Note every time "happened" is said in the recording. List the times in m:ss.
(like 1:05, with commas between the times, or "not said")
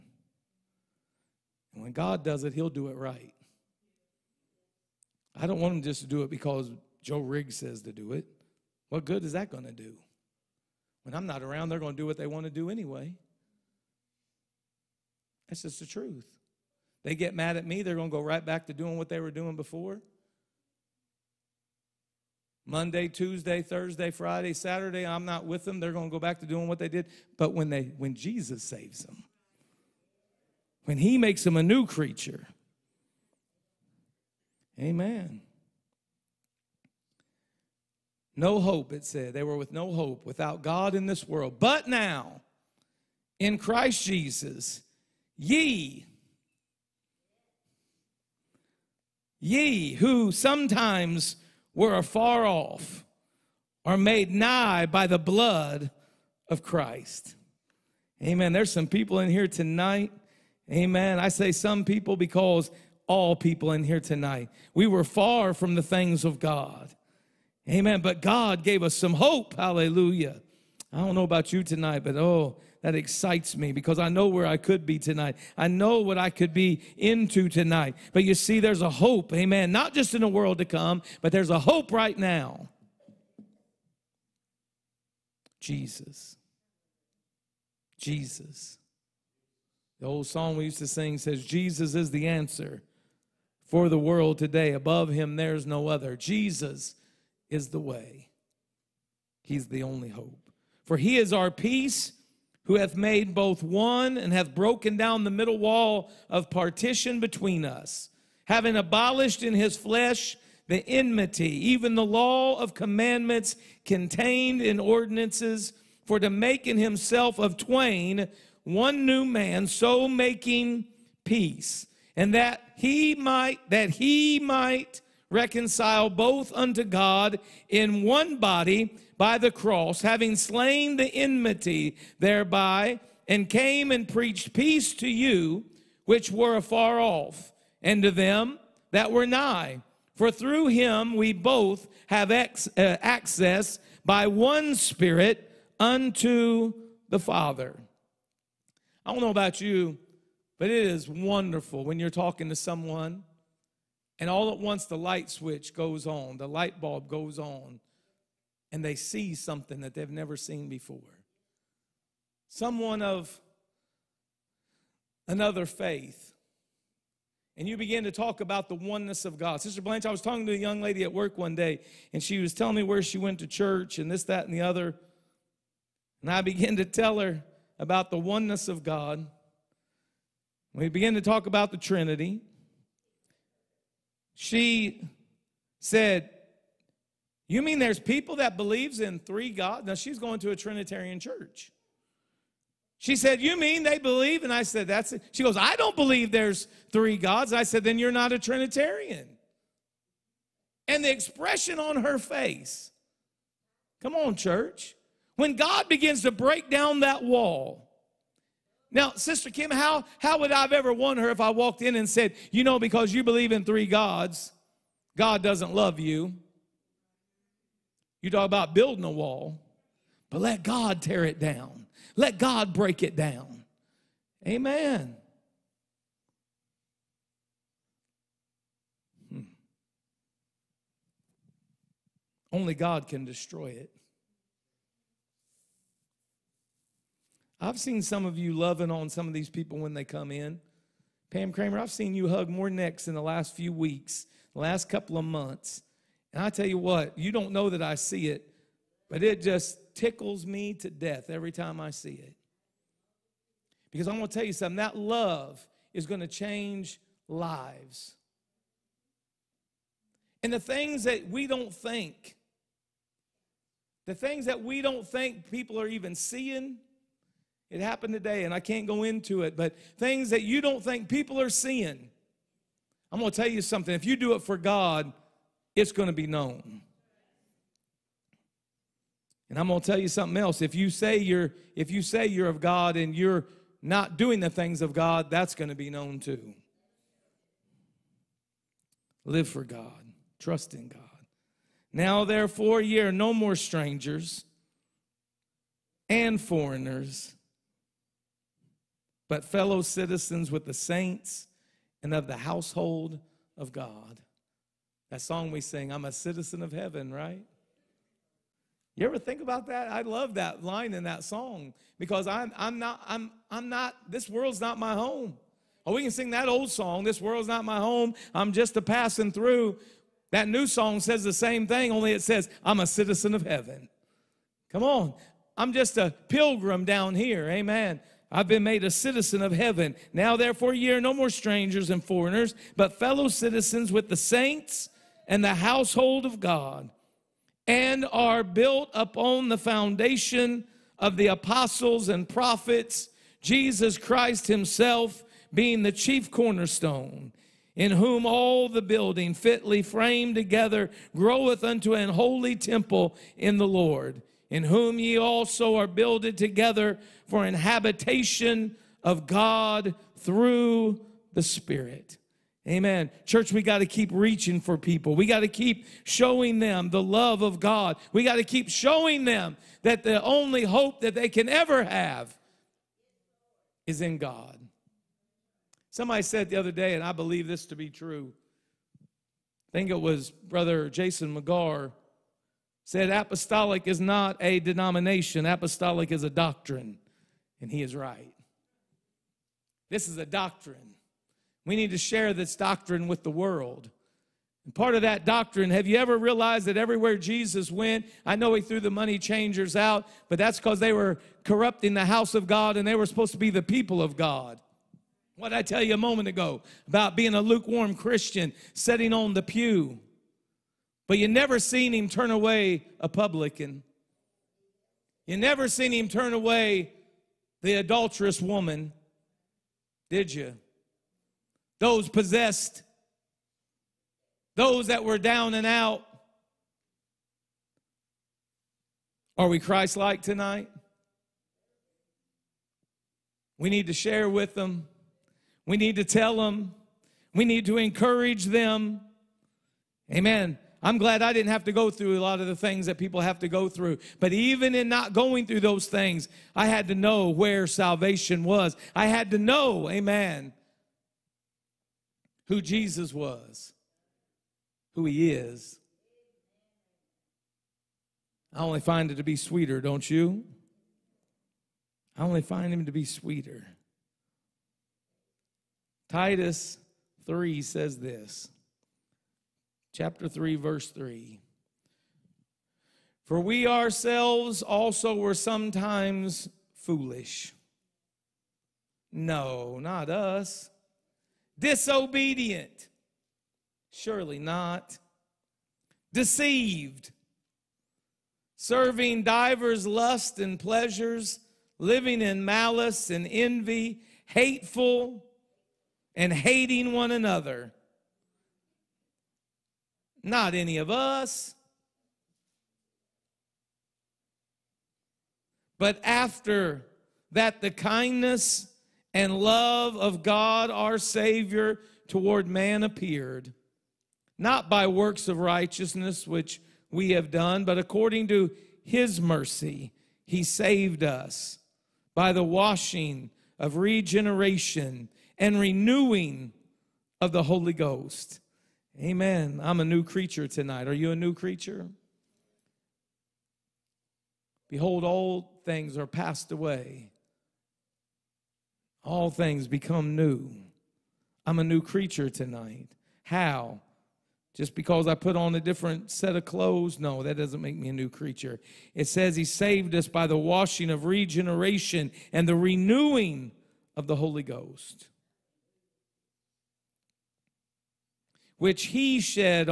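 4:27.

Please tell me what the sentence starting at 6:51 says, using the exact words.
But you never seen him turn away a publican.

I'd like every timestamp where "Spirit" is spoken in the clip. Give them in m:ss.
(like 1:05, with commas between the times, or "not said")
2:24, 6:01.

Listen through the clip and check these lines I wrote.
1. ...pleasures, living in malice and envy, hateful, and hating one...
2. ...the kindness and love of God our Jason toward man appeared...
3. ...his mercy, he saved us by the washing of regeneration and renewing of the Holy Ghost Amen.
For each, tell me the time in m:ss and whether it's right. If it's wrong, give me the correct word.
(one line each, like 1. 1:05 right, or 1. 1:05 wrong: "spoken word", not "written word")
1. 8:10 right
2. 8:27 wrong: "Savior", not "Jason"
3. 8:38 right.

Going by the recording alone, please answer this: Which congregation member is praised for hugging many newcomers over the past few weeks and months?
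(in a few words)
Pam Kramer.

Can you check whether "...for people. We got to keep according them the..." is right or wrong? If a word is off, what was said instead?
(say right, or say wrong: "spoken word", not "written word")
wrong: "showing", not "according".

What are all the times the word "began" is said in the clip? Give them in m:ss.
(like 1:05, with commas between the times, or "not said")
2:56, 3:00.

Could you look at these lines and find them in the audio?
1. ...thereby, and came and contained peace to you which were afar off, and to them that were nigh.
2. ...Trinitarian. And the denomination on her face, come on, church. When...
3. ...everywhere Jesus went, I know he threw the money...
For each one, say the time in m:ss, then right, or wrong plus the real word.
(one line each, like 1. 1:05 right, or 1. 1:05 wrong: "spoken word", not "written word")
1. 2:12 wrong: "preached", not "contained"
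2. 3:18 wrong: "expression", not "denomination"
3. 6:36 right.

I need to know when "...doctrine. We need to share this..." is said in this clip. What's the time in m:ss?
6:30.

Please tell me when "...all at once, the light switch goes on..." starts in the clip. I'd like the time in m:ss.
2:34.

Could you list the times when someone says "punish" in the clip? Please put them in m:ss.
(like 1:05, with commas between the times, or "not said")
not said.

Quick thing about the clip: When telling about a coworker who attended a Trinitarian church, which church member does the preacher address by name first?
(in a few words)
Sister Blanche.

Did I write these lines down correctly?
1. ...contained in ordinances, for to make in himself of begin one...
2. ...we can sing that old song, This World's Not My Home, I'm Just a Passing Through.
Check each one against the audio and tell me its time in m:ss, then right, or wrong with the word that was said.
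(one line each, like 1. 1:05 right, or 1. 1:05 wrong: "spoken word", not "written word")
1. 1:53 wrong: "twain", not "begin"
2. 5:15 right.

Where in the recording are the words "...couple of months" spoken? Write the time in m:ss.
4:04.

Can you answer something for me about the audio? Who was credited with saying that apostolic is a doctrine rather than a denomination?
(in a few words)
Brother Jason McGar.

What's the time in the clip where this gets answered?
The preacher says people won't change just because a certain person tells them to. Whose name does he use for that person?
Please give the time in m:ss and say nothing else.
0:07.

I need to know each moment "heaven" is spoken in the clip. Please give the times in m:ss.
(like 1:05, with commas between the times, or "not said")
5:06, 5:23, 5:29.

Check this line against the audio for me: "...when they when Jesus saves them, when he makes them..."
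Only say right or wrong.
right.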